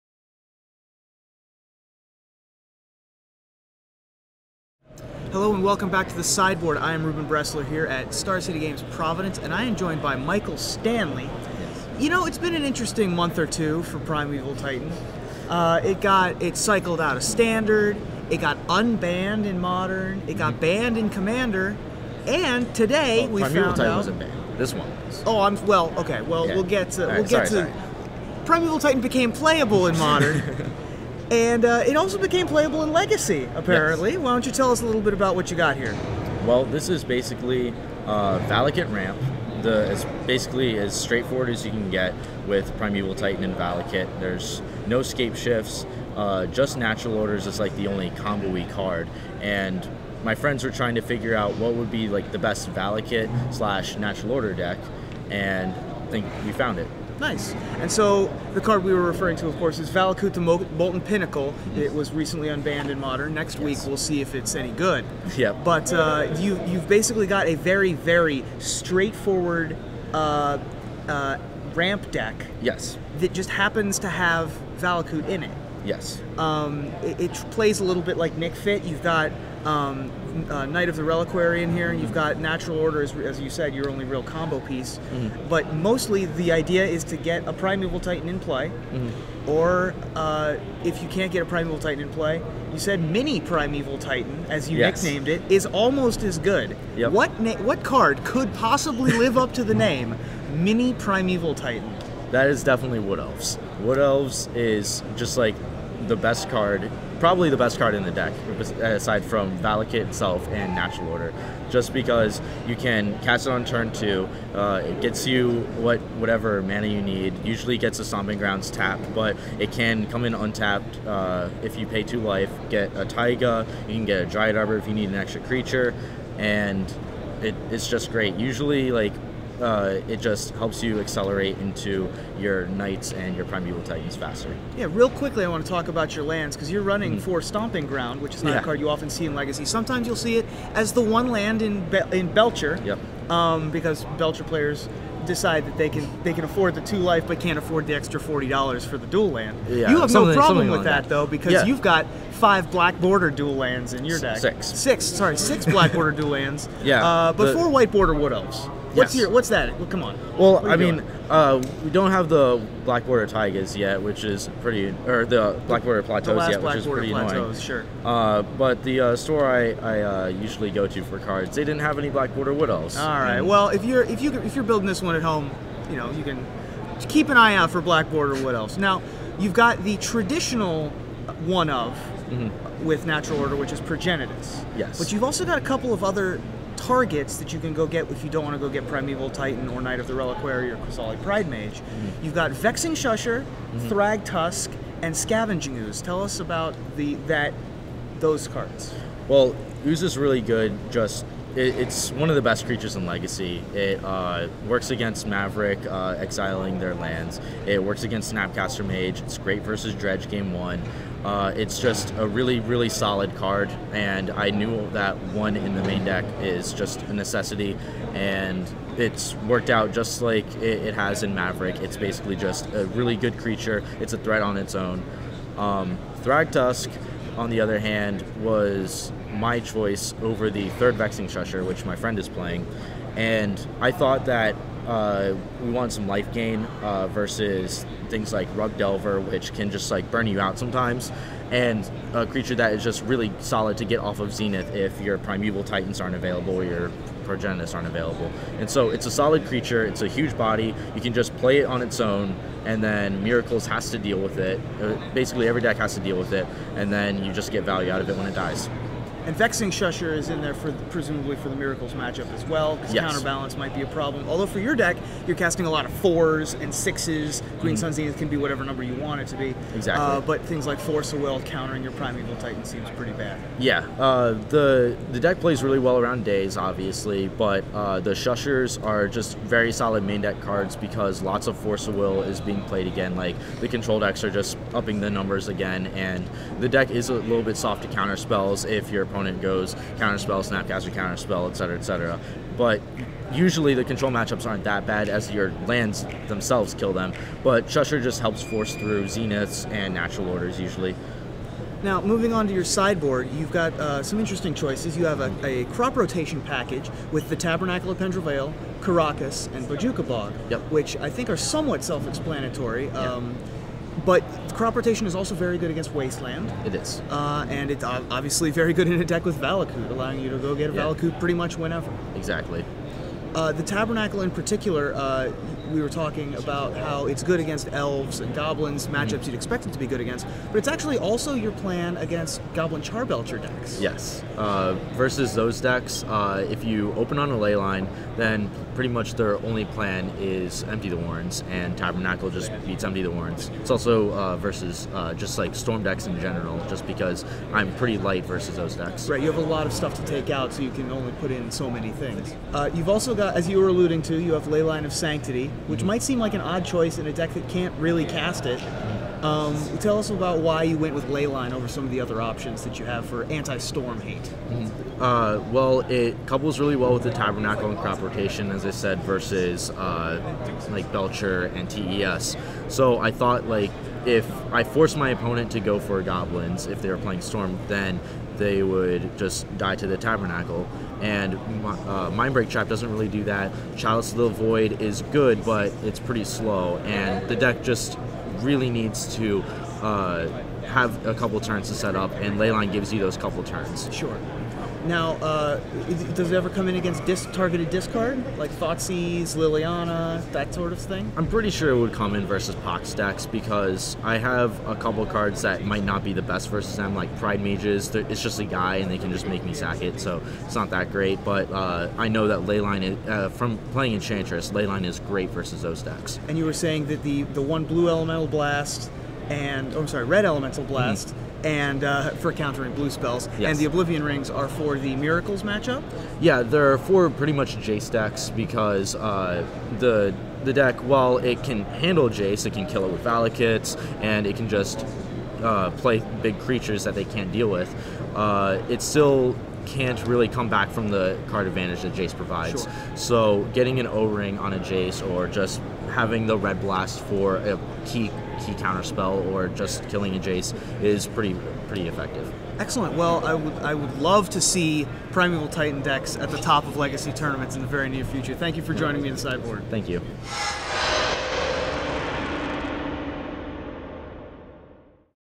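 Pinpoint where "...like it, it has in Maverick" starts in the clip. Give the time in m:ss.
3:40.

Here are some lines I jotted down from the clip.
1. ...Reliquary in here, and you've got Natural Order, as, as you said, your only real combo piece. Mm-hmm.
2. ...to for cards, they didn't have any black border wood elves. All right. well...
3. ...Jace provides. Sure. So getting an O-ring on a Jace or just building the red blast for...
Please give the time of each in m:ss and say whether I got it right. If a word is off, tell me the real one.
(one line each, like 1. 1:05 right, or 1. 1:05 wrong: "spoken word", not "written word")
1. 1:21 right
2. 2:50 right
3. 7:21 wrong: "having", not "building".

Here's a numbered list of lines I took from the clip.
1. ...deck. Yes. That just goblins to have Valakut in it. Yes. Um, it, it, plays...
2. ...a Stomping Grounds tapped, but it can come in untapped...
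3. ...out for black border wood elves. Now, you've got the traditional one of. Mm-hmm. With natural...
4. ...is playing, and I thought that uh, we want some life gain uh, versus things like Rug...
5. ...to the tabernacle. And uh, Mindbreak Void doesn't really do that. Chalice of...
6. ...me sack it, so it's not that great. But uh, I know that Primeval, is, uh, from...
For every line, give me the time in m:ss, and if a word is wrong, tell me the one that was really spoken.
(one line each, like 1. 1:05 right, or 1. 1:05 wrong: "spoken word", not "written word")
1. 1:12 wrong: "happens", not "goblins"
2. 1:57 right
3. 2:57 right
4. 3:52 right
5. 6:19 wrong: "Trap", not "Void"
6. 6:49 wrong: "Leyline", not "Primeval".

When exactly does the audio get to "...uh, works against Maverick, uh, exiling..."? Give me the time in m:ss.
3:24.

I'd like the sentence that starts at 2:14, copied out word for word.
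Yeah, real quickly, I want to talk about your lands because you're running mm-hmm.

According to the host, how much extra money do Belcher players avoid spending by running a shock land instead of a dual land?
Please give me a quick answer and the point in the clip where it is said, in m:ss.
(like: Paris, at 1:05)
40 dollars, at 2:28.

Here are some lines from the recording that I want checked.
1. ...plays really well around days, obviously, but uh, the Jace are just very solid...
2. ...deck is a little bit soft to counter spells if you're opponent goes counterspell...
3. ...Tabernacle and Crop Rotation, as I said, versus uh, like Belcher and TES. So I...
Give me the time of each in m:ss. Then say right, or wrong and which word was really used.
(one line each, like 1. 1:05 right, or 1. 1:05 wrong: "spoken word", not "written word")
1. 4:35 wrong: "Shushers", not "Jace"
2. 4:46 right
3. 6:07 right.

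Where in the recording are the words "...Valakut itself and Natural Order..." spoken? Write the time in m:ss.
1:49.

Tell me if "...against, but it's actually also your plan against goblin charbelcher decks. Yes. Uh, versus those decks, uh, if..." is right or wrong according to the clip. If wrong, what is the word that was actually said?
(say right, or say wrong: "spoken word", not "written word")
right.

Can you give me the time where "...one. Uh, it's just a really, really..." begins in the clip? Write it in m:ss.
3:30.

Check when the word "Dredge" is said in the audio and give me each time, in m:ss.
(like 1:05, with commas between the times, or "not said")
3:29.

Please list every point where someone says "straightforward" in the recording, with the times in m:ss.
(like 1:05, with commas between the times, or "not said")
0:40, 1:08.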